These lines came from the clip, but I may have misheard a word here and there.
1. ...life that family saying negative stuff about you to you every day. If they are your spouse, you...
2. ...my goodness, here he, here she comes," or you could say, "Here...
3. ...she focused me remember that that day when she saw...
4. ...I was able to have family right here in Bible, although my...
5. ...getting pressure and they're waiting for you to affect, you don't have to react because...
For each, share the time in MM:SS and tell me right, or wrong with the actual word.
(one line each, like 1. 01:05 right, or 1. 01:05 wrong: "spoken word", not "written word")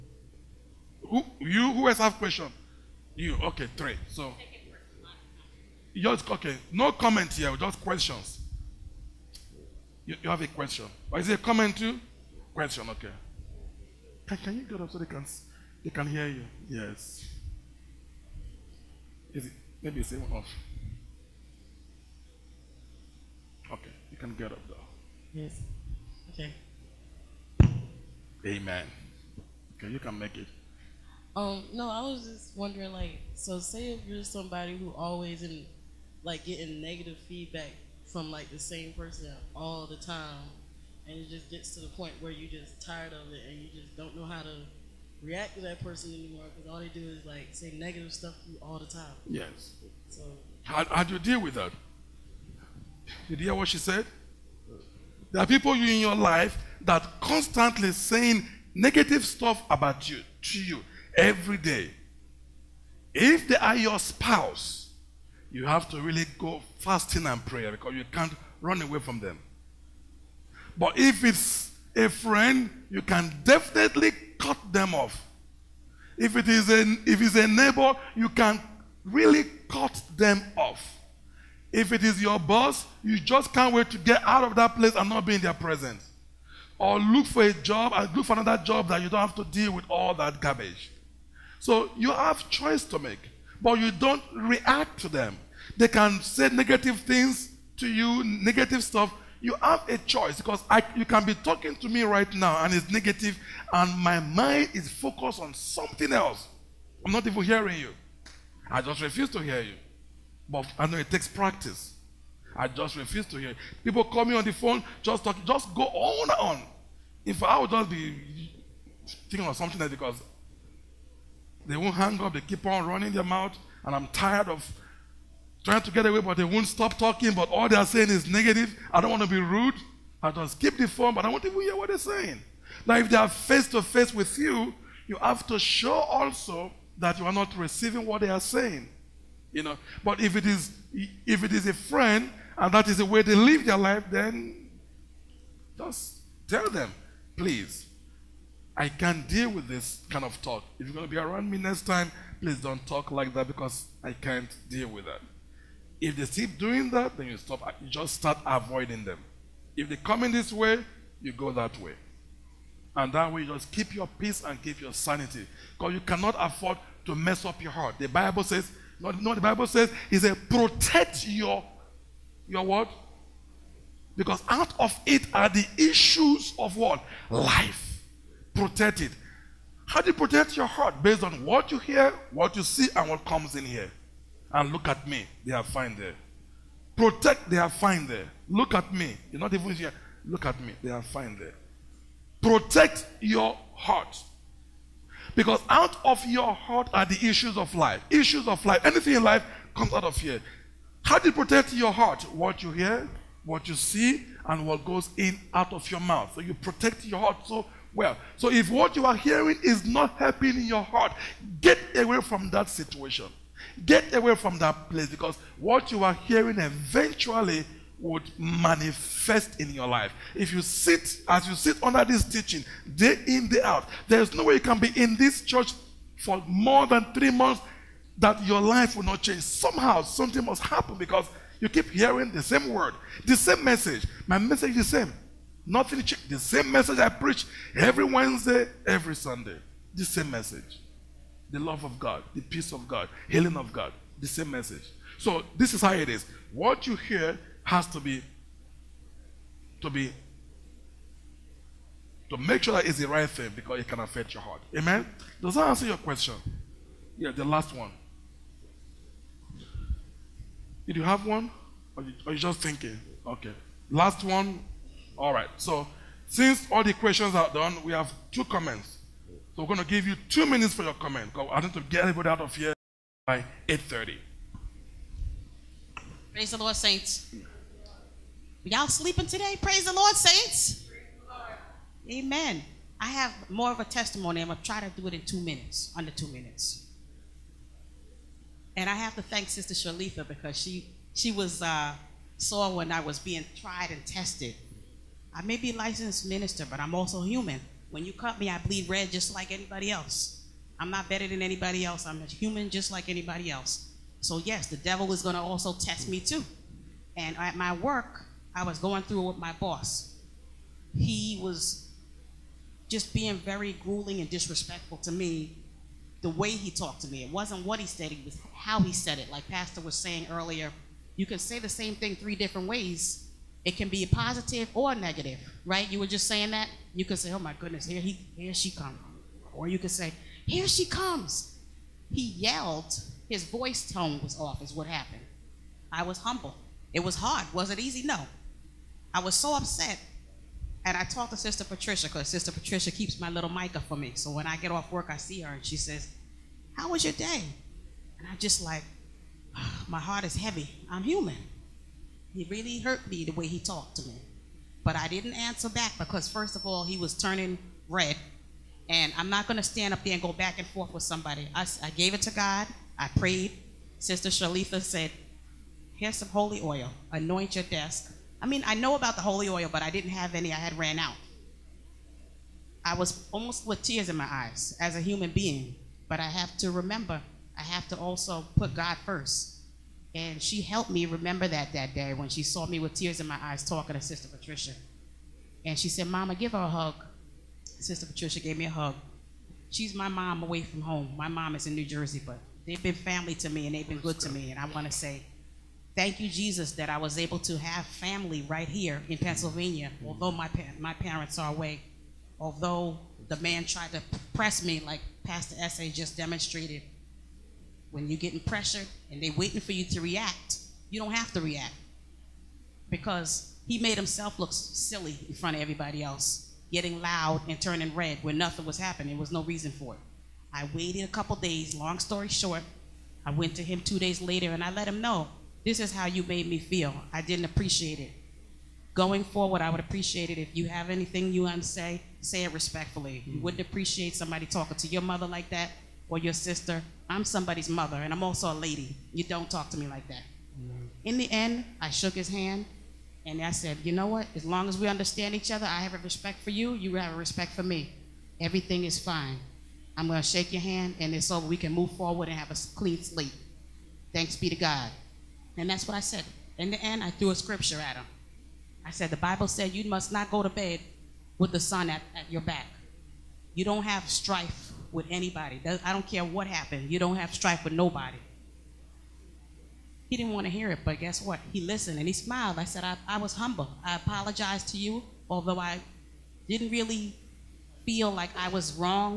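1. 00:56 wrong: "constantly", not "family"
2. 05:27 right
3. 06:20 wrong: "helped", not "focused"
4. 06:36 wrong: "Pennsylvania", not "Bible"
5. 06:48 wrong: "react", not "affect".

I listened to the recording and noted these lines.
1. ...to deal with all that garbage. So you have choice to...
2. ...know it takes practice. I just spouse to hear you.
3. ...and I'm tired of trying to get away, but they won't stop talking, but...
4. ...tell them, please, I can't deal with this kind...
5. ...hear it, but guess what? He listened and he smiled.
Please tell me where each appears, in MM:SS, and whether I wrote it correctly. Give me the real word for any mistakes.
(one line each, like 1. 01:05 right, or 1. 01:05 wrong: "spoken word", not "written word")
1. 01:29 right
2. 01:50 wrong: "refuse", not "spouse"
3. 02:03 right
4. 02:26 right
5. 07:50 right.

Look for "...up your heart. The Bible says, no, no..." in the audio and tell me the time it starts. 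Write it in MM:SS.
02:47.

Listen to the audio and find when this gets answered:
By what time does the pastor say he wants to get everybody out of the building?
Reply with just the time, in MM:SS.
04:33.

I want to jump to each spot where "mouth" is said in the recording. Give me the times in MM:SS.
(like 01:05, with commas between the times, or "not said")
02:03, 03:26.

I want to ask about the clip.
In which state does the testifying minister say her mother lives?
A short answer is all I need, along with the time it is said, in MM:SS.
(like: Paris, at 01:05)
New Jersey, at 06:31.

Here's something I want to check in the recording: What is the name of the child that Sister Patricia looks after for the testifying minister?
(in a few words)
Micah.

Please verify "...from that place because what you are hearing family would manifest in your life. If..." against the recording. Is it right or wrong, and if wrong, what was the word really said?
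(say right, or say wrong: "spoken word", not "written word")
wrong: "eventually", not "family".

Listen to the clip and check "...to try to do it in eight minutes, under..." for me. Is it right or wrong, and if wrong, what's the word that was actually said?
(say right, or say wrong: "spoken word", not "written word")
wrong: "two", not "eight".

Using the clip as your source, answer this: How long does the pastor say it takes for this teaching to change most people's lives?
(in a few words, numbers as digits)
3 months.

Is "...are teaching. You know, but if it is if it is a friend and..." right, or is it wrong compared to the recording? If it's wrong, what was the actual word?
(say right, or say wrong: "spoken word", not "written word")
wrong: "saying", not "teaching".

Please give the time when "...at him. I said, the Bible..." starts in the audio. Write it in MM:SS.
07:37.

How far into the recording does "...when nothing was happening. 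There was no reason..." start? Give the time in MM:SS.
06:58.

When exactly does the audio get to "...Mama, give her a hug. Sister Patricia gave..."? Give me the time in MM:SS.
06:26.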